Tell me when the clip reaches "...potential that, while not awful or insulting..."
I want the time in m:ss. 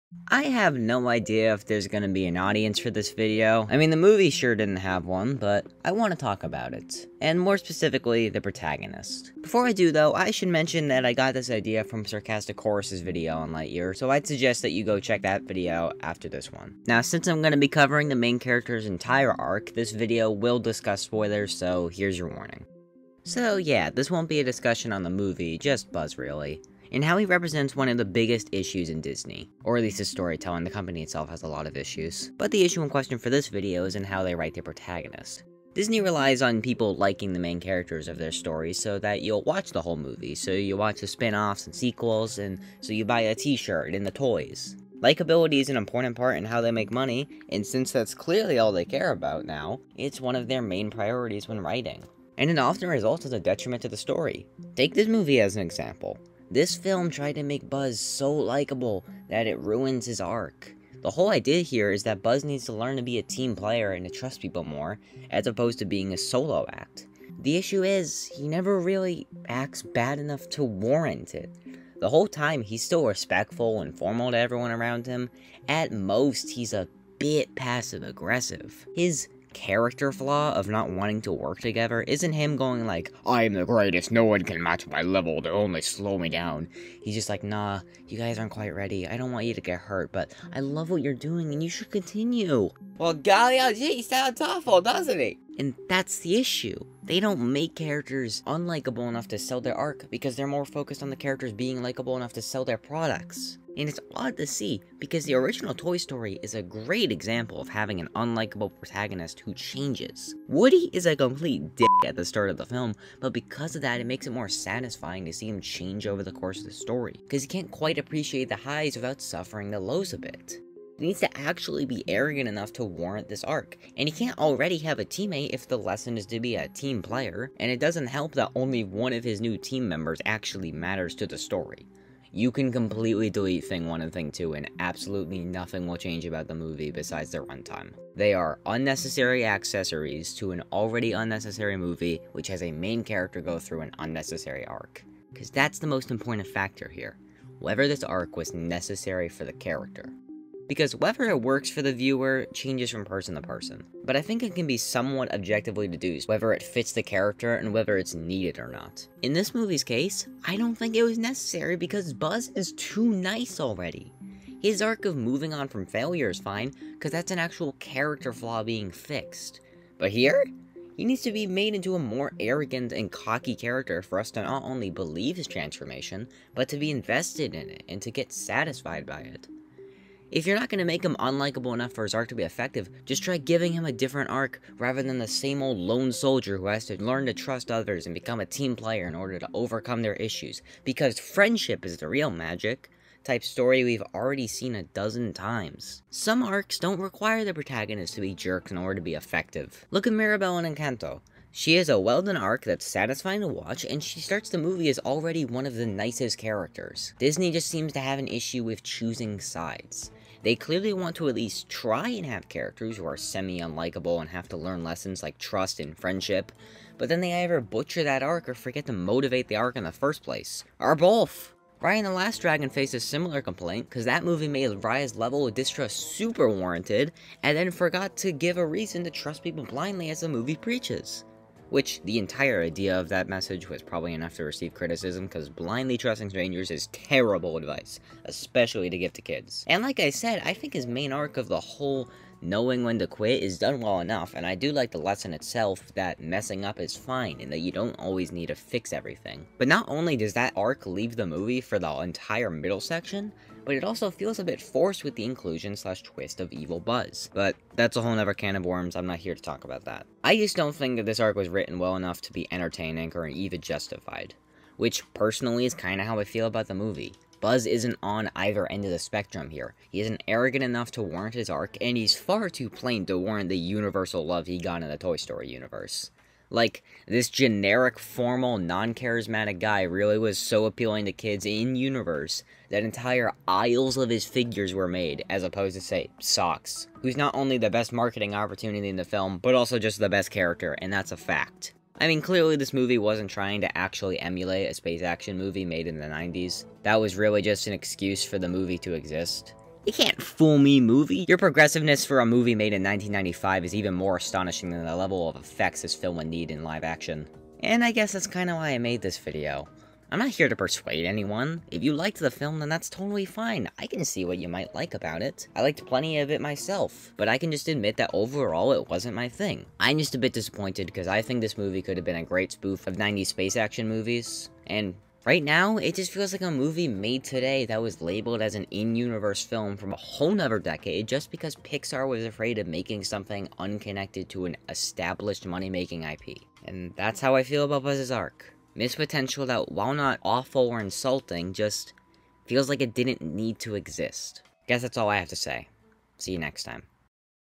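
5:38.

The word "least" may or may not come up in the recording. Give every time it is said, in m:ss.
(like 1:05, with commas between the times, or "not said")
0:29, 3:31.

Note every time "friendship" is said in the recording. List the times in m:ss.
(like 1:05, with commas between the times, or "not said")
3:11, 3:35.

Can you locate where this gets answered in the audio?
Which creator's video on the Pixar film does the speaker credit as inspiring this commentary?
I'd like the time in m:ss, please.
0:12.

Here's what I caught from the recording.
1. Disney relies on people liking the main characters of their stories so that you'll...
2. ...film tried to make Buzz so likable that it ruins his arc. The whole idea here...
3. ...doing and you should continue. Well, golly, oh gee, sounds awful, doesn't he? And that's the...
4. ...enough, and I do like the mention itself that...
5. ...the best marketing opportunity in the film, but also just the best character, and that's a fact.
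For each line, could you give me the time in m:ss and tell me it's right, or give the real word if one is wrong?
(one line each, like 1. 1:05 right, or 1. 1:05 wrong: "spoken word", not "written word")
1. 0:35 right
2. 0:56 right
3. 1:31 right
4. 4:03 wrong: "lesson", not "mention"
5. 4:47 right.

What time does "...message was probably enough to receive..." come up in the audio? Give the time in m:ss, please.
3:53.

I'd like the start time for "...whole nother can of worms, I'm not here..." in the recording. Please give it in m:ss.
4:18.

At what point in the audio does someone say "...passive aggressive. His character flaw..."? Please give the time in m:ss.
1:17.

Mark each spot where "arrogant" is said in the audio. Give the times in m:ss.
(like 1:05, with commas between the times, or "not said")
2:02, 2:52, 4:30.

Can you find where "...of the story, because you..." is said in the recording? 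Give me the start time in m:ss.
1:56.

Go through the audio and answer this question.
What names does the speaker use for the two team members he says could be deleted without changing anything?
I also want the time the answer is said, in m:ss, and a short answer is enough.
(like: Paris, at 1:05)
Thing 1 and Thing 2, at 2:13.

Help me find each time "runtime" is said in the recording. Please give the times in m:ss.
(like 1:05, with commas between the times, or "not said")
2:17.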